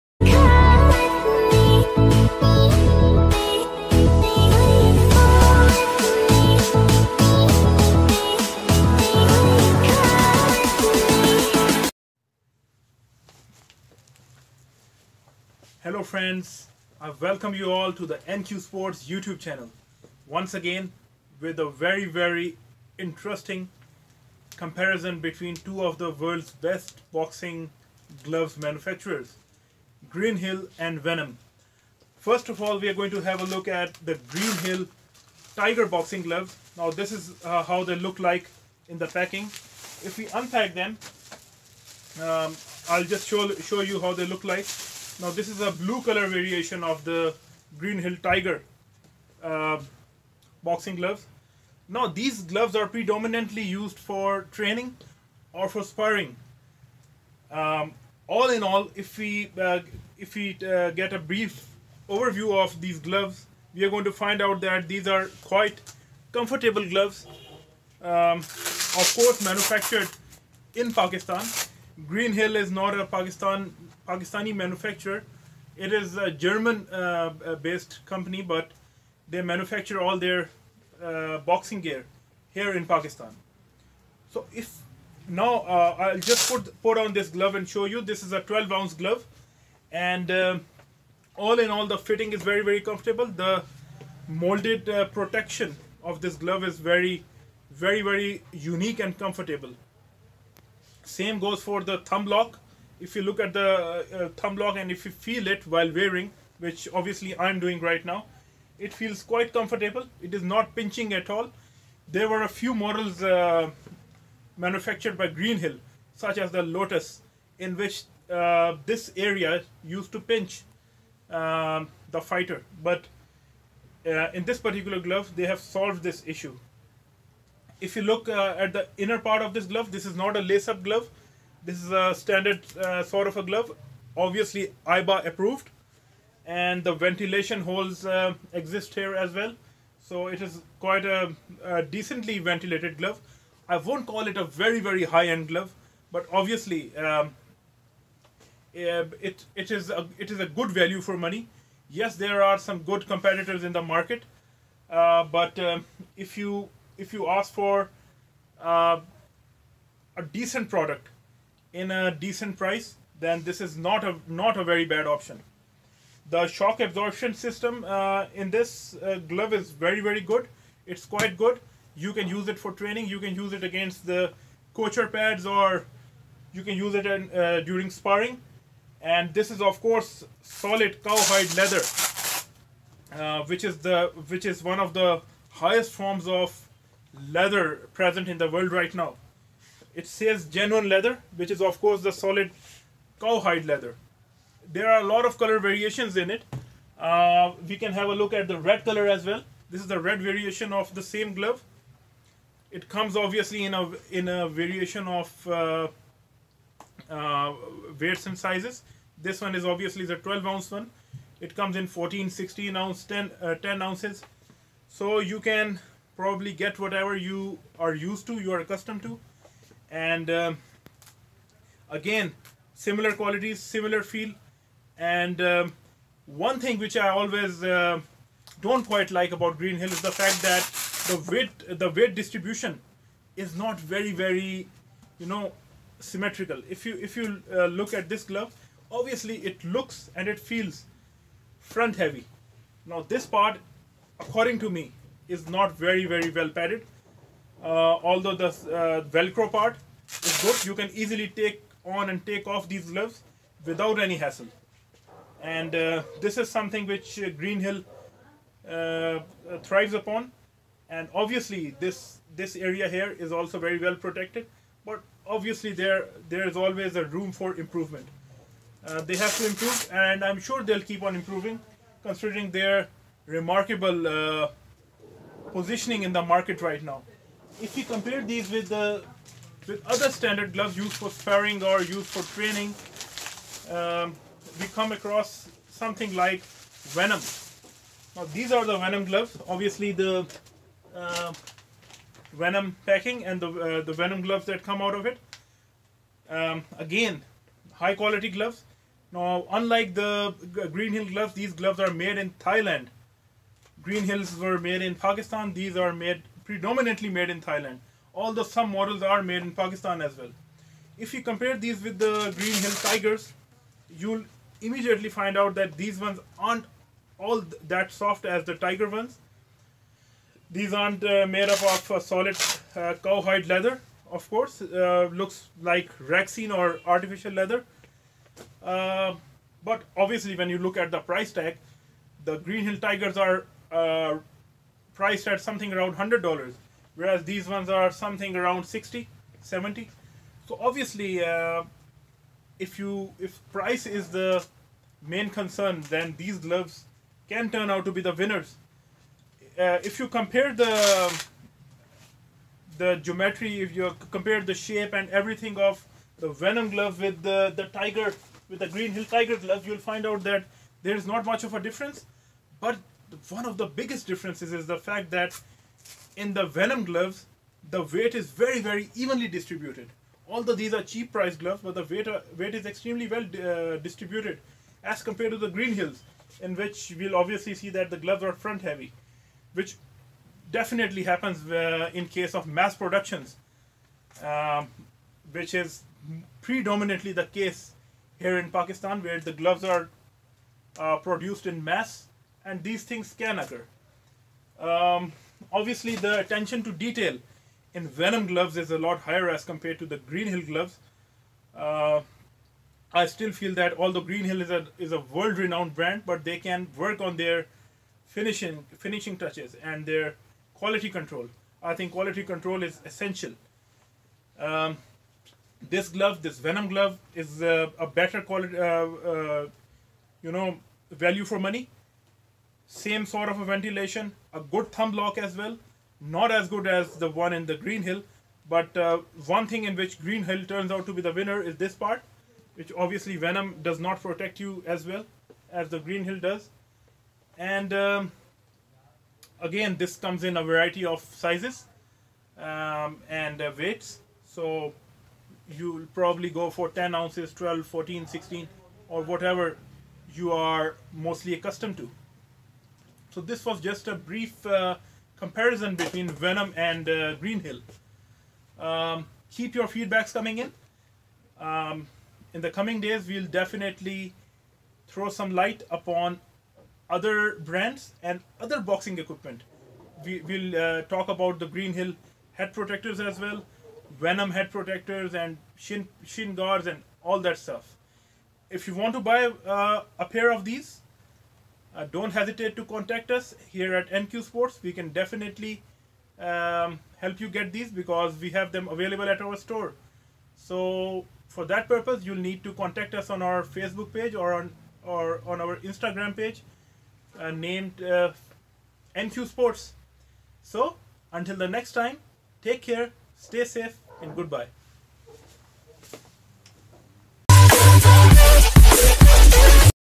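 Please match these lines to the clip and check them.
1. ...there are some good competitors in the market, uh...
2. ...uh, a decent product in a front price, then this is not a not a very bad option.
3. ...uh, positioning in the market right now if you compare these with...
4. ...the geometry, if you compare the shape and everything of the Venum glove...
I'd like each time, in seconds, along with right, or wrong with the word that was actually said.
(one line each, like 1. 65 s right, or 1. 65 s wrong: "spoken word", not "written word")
1. 152 s right
2. 158 s wrong: "decent", not "front"
3. 274 s right
4. 352 s right.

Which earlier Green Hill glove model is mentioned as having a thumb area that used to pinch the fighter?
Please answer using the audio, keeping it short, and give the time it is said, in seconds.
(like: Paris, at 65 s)
Lotus, at 116 s.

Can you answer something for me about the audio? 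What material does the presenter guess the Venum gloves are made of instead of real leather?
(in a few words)
Rexine.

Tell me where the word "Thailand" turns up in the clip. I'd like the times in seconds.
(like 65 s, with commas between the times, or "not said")
302 s, 307 s.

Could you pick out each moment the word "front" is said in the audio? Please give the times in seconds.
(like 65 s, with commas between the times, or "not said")
241 s, 378 s.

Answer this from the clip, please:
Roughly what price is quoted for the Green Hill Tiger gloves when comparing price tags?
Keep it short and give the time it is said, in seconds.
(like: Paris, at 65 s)
$100, at 335 s.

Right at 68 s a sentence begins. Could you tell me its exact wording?
Um, of course, manufactured in Pakistan.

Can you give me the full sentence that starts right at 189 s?
It says genuine leather, which is of course the solid cowhide leather.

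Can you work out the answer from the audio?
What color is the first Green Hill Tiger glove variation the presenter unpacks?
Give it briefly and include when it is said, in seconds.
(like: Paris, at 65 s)
Blue, at 45 s.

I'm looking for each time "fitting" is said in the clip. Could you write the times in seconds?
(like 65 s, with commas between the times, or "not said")
91 s.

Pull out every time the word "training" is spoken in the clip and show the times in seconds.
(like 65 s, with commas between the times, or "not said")
54 s, 172 s, 282 s.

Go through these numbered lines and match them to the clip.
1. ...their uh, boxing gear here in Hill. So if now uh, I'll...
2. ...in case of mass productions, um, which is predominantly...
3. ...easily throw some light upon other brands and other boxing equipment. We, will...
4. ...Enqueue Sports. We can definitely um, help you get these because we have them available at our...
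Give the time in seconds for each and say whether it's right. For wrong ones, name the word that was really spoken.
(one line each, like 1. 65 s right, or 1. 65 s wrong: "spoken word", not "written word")
1. 80 s wrong: "Pakistan", not "Hill"
2. 381 s right
3. 463 s wrong: "definitely", not "easily"
4. 483 s right.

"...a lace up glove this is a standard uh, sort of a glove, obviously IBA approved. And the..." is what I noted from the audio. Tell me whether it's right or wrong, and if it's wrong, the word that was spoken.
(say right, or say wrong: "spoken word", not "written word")
right.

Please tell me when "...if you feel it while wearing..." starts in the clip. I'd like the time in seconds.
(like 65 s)
104 s.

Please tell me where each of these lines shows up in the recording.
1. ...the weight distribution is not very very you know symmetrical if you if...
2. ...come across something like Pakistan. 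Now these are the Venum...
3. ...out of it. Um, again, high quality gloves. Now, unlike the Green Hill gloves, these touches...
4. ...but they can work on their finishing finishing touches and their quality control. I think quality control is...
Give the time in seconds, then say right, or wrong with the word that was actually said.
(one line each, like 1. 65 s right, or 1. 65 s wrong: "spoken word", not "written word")
1. 231 s right
2. 284 s wrong: "Venum", not "Pakistan"
3. 294 s wrong: "gloves", not "touches"
4. 406 s right.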